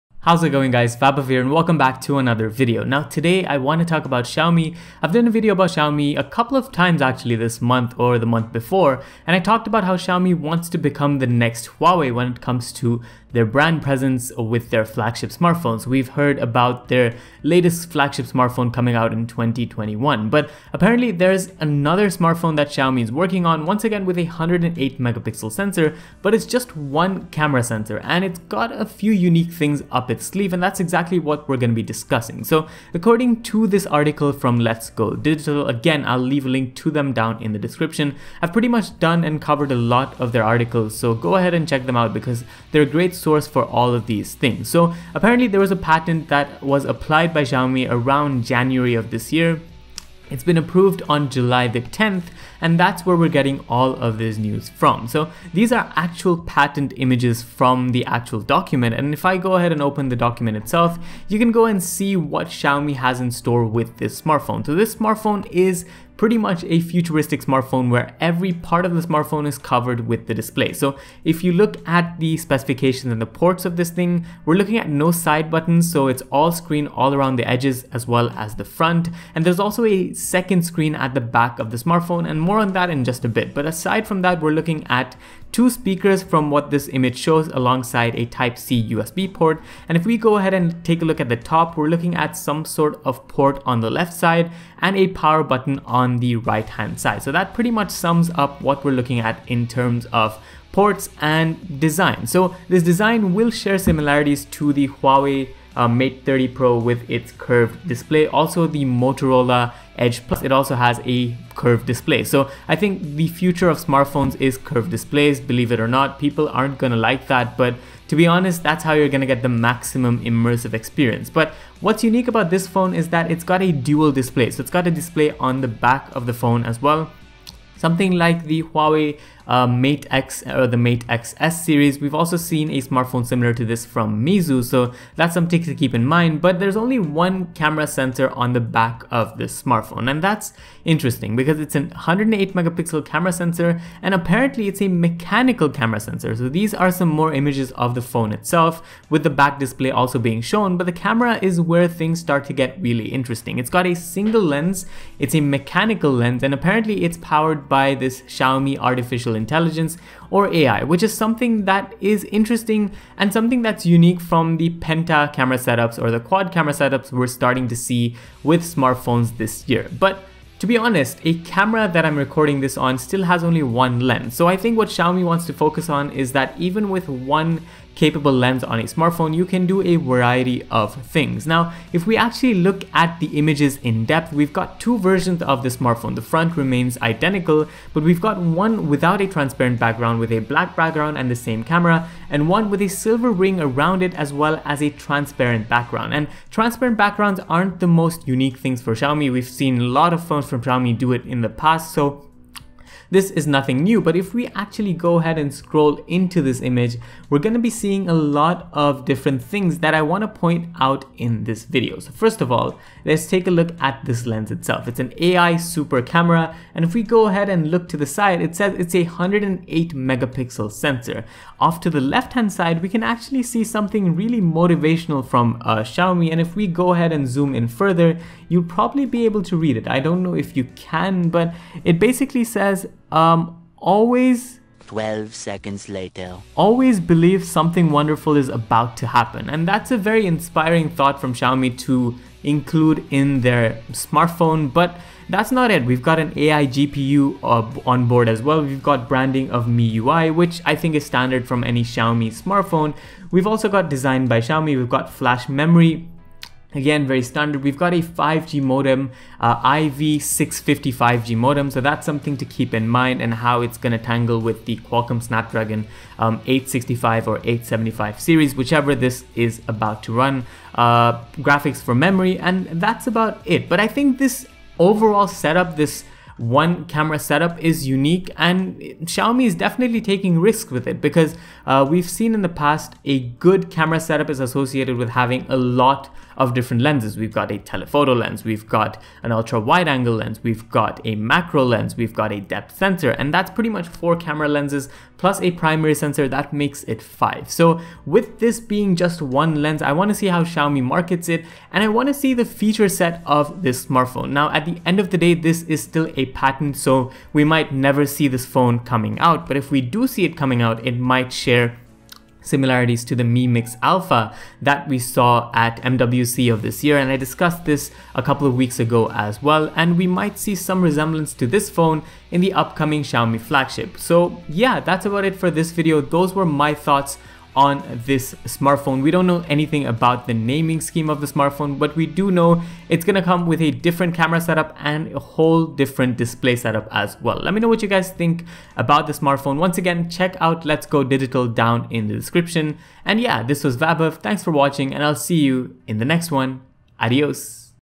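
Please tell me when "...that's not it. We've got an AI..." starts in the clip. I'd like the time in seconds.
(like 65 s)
245 s.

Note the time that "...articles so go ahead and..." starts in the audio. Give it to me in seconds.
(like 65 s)
40 s.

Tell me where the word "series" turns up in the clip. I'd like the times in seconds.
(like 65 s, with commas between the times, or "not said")
131 s, 268 s.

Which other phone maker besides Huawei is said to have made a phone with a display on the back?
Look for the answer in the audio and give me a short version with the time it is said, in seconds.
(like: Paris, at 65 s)
Meizu, at 134 s.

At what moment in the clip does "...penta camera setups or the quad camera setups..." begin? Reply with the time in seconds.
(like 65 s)
164 s.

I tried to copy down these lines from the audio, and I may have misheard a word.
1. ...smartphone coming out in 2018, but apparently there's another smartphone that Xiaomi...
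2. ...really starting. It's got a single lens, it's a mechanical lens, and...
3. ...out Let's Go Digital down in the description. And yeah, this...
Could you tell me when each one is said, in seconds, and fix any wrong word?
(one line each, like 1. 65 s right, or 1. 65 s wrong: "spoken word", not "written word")
1. 18 s wrong: "2021", not "2018"
2. 152 s wrong: "interesting", not "starting"
3. 340 s right.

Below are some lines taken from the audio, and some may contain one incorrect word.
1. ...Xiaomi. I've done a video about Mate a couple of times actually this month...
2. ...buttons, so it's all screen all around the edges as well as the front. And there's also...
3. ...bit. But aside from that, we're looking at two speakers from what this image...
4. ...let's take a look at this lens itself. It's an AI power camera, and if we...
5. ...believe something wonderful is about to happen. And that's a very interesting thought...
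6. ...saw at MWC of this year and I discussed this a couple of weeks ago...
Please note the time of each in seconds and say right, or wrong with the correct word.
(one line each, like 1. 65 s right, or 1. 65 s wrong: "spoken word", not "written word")
1. 4 s wrong: "Xiaomi", not "Mate"
2. 75 s right
3. 83 s right
4. 213 s wrong: "super", not "power"
5. 236 s wrong: "inspiring", not "interesting"
6. 314 s right.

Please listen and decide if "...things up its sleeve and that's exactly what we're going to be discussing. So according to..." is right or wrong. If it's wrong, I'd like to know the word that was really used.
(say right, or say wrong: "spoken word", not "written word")
right.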